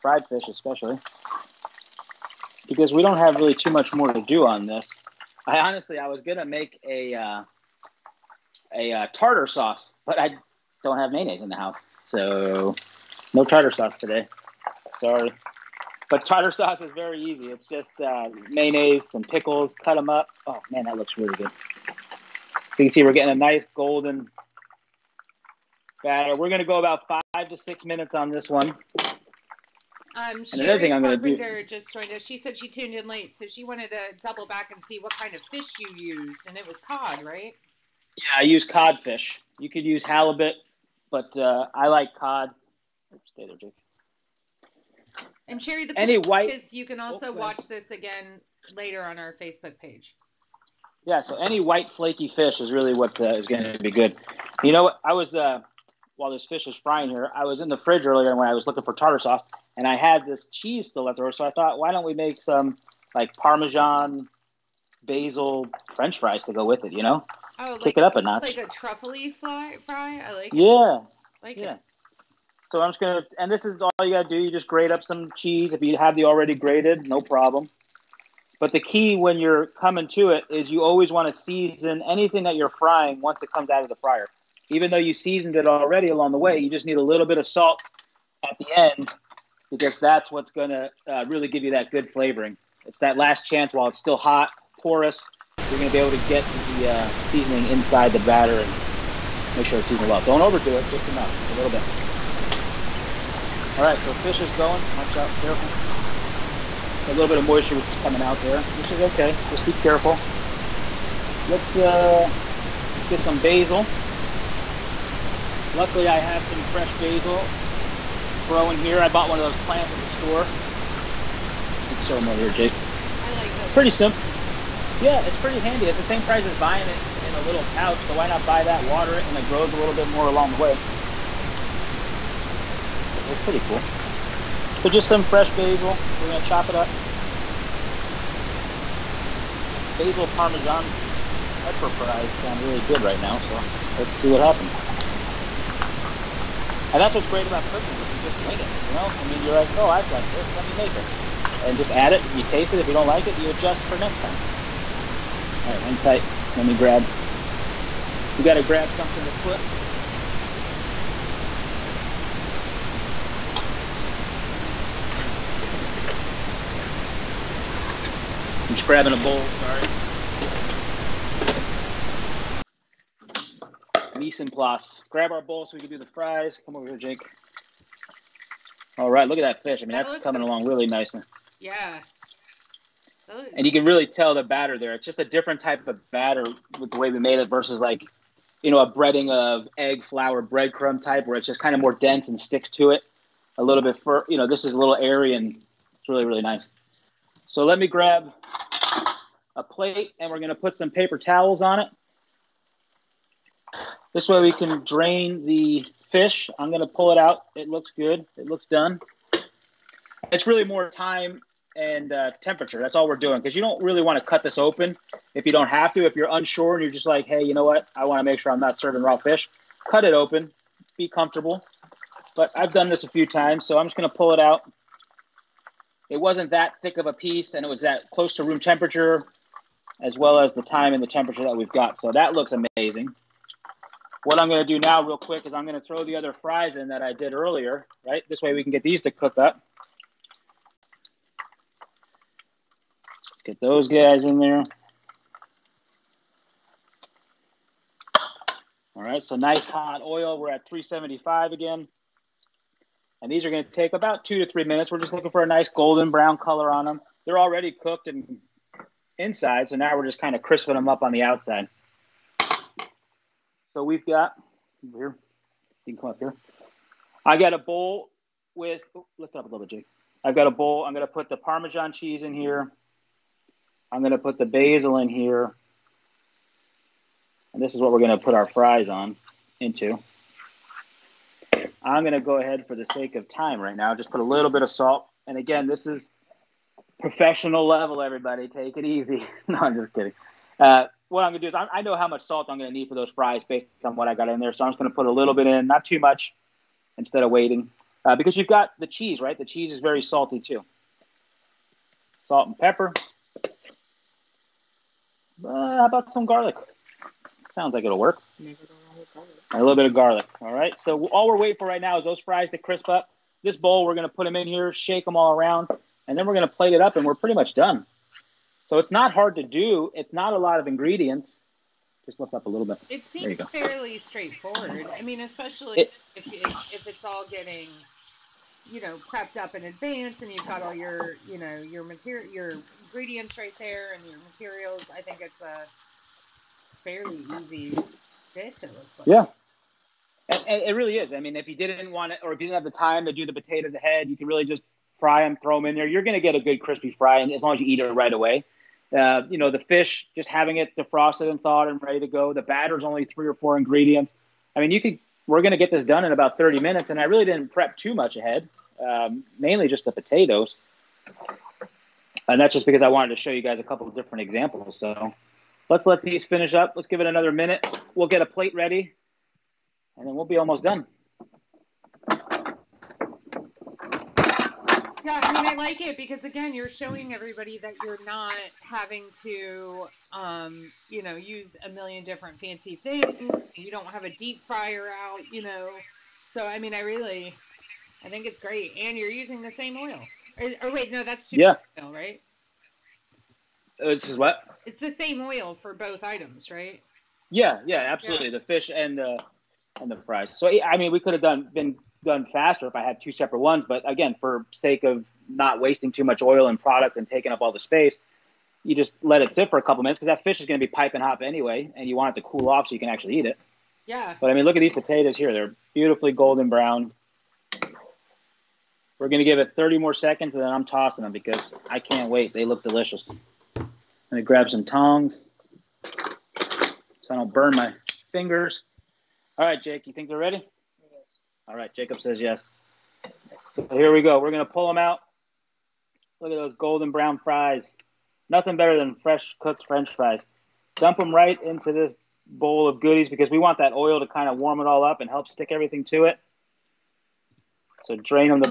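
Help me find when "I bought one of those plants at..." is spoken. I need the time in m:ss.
1:59.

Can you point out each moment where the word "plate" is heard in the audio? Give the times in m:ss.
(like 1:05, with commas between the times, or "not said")
3:19, 5:16, 6:08.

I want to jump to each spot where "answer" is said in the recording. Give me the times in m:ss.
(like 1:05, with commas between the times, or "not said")
not said.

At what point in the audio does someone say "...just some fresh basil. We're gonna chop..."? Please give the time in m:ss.
2:14.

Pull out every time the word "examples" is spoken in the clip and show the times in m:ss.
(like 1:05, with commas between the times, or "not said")
6:04.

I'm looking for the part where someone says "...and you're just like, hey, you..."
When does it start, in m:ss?
3:36.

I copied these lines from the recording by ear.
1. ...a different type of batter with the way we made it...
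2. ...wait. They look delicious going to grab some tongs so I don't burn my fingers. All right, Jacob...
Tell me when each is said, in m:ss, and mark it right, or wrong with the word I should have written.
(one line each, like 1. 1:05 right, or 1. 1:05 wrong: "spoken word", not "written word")
1. 3:05 right
2. 7:02 wrong: "Jake", not "Jacob".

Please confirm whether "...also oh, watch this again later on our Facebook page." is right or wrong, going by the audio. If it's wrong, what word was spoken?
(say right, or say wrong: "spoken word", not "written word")
right.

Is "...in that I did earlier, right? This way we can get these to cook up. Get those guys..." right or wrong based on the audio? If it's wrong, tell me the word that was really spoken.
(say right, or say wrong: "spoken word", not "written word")
right.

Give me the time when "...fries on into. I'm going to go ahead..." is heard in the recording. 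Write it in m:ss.
4:38.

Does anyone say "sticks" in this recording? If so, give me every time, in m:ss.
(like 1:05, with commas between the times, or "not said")
3:12, 7:25.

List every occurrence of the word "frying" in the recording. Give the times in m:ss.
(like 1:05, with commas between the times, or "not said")
0:56, 1:22.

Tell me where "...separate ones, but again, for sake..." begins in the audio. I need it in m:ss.
6:43.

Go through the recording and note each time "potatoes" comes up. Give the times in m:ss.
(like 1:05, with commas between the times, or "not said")
5:43, 5:59, 6:54.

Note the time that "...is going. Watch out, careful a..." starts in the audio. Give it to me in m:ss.
1:44.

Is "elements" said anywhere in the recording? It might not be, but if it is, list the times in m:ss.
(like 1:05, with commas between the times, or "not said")
not said.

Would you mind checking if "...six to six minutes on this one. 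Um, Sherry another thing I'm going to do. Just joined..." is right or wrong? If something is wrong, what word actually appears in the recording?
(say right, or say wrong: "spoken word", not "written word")
wrong: "five", not "six".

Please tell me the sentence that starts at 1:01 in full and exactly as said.
So I thought, why don't we make some like Parmesan basil French fries to go with it?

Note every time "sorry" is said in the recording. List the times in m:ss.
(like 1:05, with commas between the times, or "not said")
0:14, 2:49.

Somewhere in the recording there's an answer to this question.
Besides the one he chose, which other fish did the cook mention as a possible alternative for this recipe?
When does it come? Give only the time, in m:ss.
0:40.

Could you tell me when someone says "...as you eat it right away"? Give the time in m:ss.
5:47.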